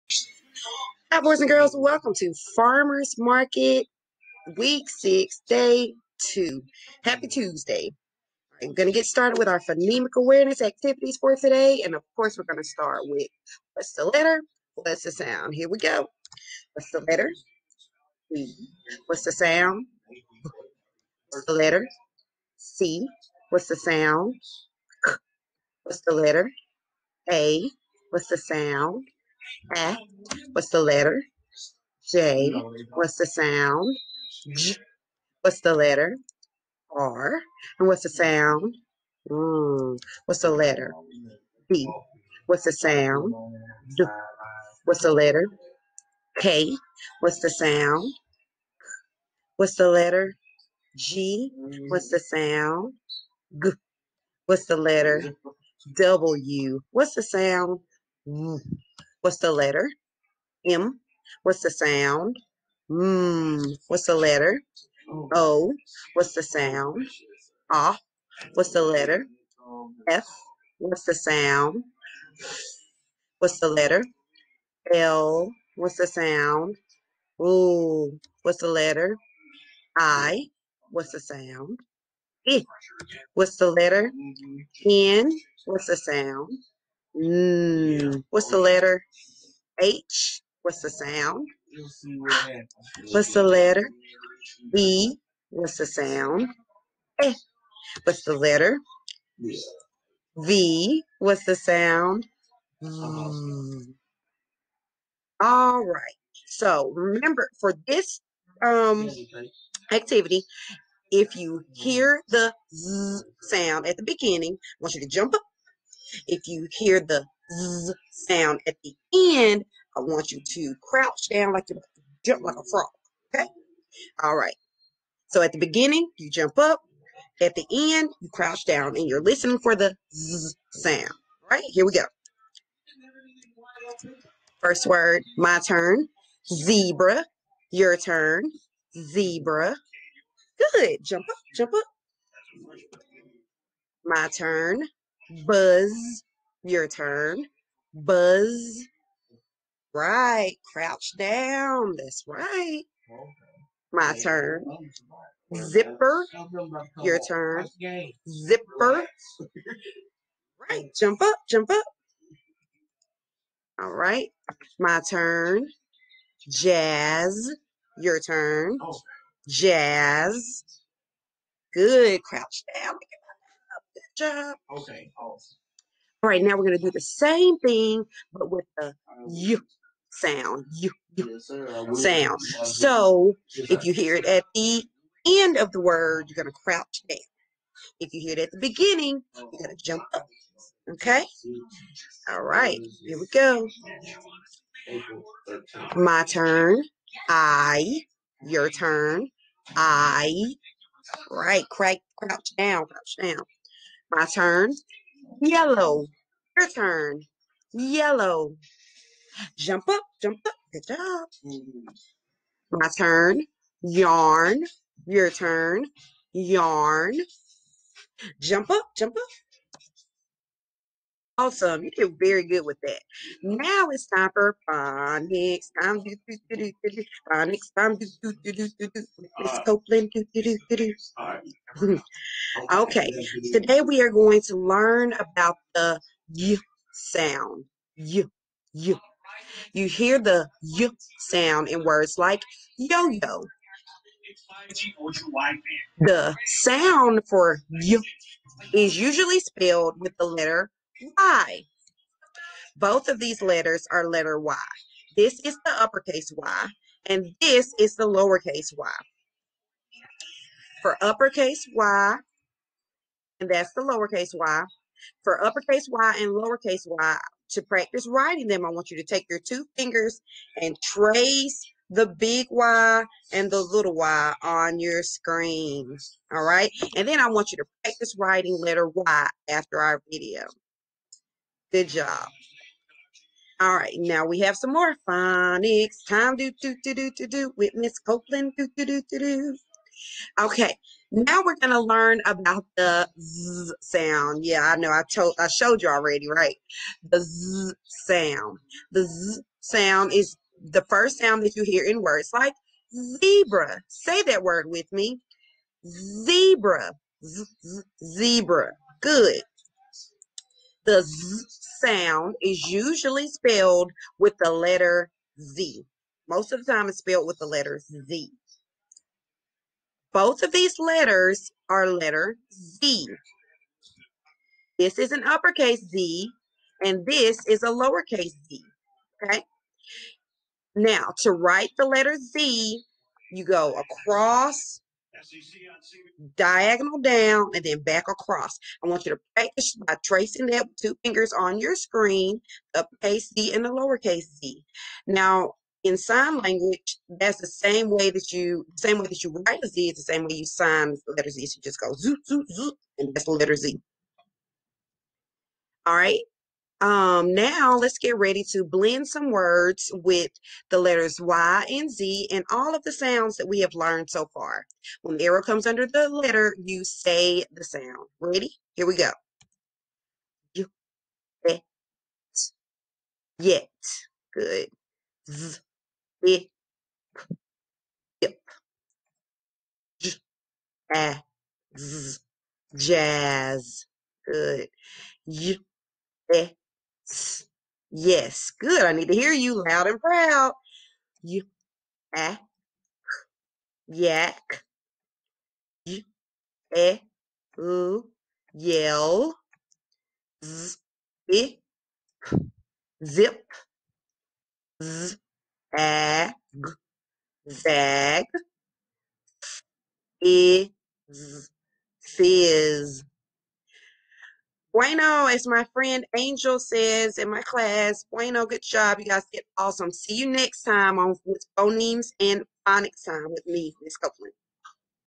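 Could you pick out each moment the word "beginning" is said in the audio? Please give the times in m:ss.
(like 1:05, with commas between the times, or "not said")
1:54, 2:05, 3:08.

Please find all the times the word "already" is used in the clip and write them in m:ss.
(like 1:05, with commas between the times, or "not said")
4:55.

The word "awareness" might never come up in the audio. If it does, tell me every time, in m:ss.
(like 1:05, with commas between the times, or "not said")
0:10.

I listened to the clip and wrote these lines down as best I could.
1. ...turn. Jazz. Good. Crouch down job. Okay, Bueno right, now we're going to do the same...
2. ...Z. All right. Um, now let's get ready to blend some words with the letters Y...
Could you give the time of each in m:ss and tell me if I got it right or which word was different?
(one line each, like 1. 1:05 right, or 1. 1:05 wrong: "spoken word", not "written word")
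1. 2:48 wrong: "All", not "Bueno"
2. 5:53 right.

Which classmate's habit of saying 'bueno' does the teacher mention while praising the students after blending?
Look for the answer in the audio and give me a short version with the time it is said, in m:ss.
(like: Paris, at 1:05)
Angel, at 6:56.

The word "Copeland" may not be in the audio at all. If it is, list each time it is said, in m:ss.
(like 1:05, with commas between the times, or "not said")
3:49, 4:47, 7:03.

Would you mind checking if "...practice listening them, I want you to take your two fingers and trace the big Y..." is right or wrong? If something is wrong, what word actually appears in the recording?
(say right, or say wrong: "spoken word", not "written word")
wrong: "writing", not "listening".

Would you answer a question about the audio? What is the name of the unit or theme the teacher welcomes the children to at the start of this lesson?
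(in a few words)
Farmers Market.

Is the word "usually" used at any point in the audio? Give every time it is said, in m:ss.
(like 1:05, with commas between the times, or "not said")
4:08, 5:12.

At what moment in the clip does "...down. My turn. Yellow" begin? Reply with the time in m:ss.
3:23.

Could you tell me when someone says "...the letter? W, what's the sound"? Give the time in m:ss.
0:54.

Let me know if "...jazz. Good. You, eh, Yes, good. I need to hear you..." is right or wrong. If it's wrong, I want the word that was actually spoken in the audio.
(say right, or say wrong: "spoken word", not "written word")
right.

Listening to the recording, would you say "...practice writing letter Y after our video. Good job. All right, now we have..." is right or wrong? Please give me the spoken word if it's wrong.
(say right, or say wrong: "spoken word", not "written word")
right.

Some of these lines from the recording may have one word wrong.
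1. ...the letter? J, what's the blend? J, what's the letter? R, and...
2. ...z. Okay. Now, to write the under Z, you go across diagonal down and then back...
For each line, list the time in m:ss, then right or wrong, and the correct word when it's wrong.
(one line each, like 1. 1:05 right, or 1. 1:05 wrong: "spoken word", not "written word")
1. 0:30 wrong: "sound", not "blend"
2. 5:28 wrong: "letter", not "under".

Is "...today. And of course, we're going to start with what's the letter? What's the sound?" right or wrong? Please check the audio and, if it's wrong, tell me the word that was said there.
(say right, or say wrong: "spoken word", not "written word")
right.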